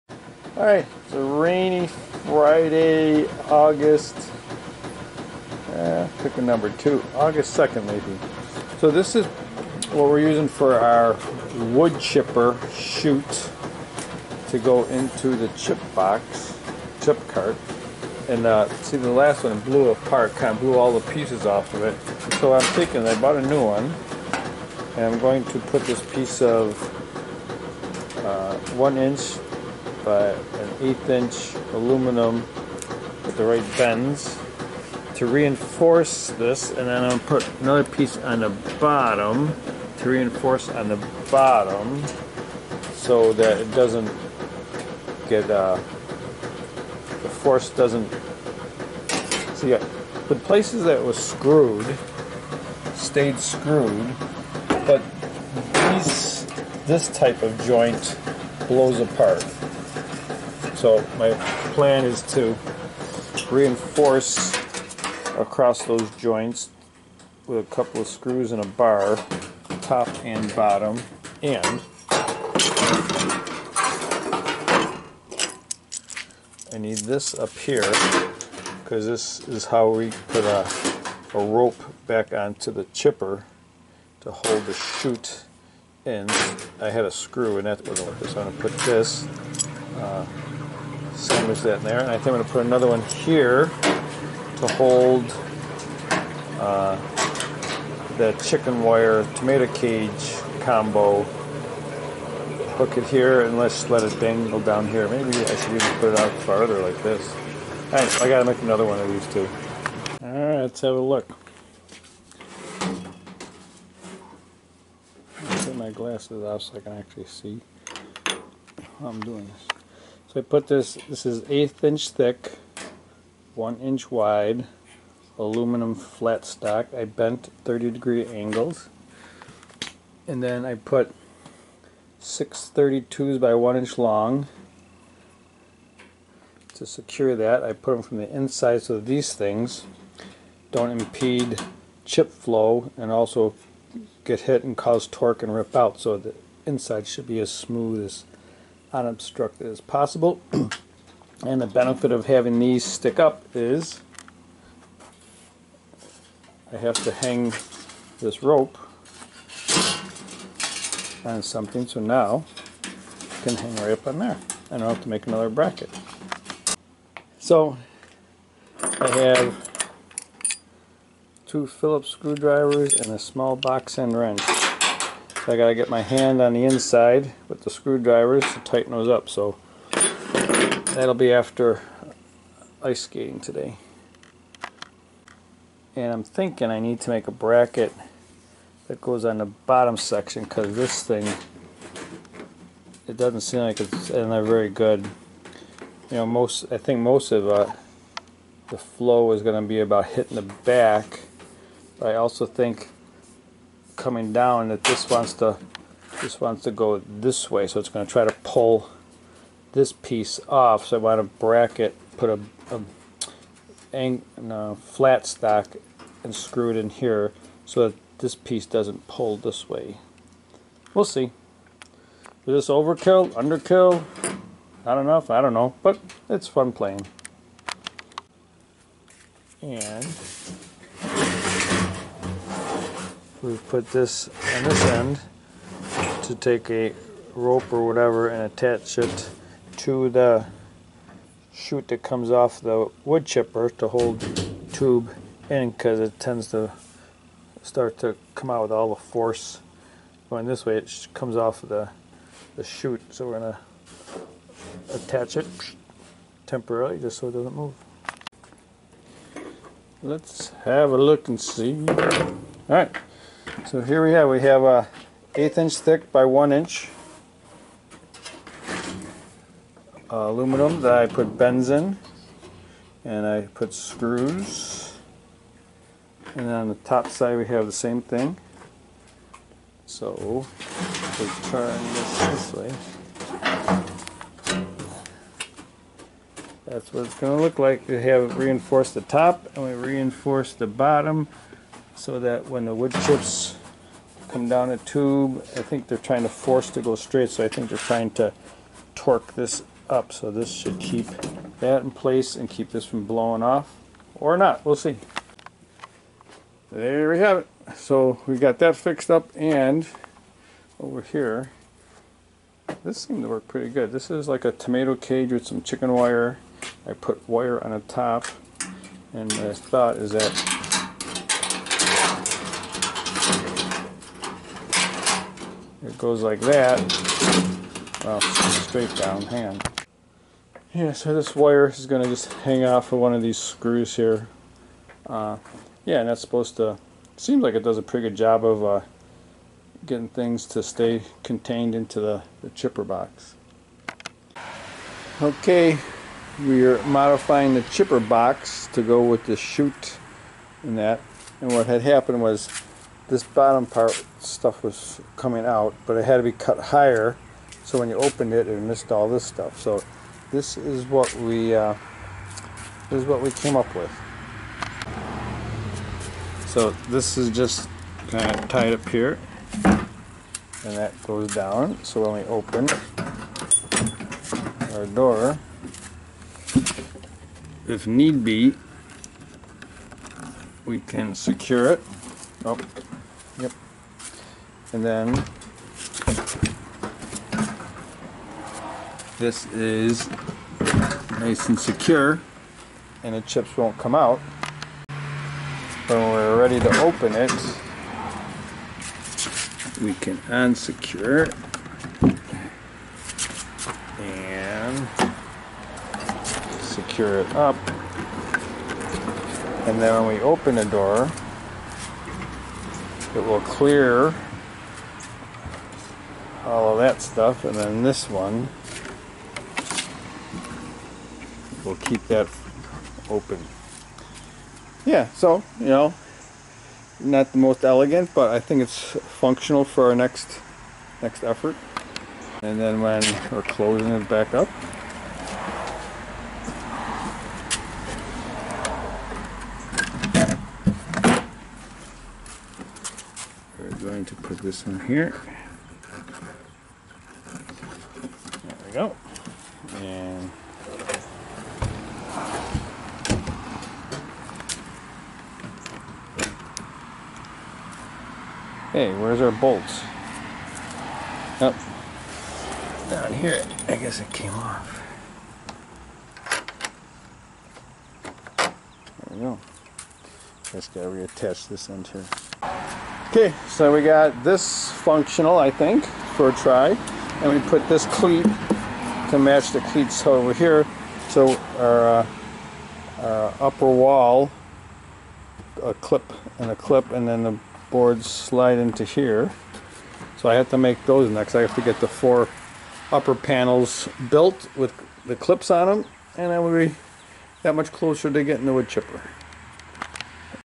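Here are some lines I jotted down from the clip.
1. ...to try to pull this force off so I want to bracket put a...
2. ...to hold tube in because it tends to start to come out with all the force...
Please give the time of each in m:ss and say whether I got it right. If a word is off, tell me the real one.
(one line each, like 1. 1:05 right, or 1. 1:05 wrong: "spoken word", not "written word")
1. 3:28 wrong: "piece", not "force"
2. 4:03 right.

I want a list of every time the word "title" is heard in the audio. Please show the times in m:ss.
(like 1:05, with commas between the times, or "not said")
not said.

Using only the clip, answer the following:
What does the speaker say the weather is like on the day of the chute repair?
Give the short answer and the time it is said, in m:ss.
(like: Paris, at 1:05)
rainy, at 0:01.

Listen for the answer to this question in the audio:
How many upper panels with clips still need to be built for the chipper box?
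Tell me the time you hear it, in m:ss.
8:11.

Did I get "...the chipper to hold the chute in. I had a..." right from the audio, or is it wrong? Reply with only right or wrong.
right.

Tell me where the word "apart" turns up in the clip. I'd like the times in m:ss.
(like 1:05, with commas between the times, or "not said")
0:19, 0:58.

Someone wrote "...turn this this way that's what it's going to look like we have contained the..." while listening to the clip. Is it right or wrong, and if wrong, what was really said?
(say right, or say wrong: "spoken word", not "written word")
wrong: "reinforced", not "contained".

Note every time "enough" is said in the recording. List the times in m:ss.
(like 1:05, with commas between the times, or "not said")
3:44.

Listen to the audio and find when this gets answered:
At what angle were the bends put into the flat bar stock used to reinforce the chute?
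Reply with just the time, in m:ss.
2:07.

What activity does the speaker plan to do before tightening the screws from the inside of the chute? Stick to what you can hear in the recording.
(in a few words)
ice skating.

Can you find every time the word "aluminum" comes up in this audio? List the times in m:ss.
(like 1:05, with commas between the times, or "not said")
0:31, 2:05, 4:30.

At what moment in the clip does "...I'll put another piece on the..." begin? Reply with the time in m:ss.
0:37.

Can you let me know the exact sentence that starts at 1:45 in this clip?
Maybe I should even put it out farther like this.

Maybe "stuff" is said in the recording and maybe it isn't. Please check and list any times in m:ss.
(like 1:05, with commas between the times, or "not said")
5:54, 5:59, 6:57.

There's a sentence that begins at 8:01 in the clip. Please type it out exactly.
So our, uh, our upper wall, a clip and a clip, and then the boards slide into here.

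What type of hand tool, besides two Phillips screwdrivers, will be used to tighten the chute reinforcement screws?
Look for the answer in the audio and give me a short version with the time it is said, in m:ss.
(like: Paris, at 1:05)
box end wrench, at 2:53.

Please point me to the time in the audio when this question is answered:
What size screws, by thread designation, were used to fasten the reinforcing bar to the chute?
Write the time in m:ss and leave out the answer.
2:12.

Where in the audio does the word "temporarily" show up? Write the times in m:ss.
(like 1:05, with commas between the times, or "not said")
4:16.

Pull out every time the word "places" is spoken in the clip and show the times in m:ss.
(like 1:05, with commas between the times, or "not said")
0:50, 5:01.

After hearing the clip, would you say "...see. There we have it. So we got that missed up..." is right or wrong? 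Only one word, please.
wrong.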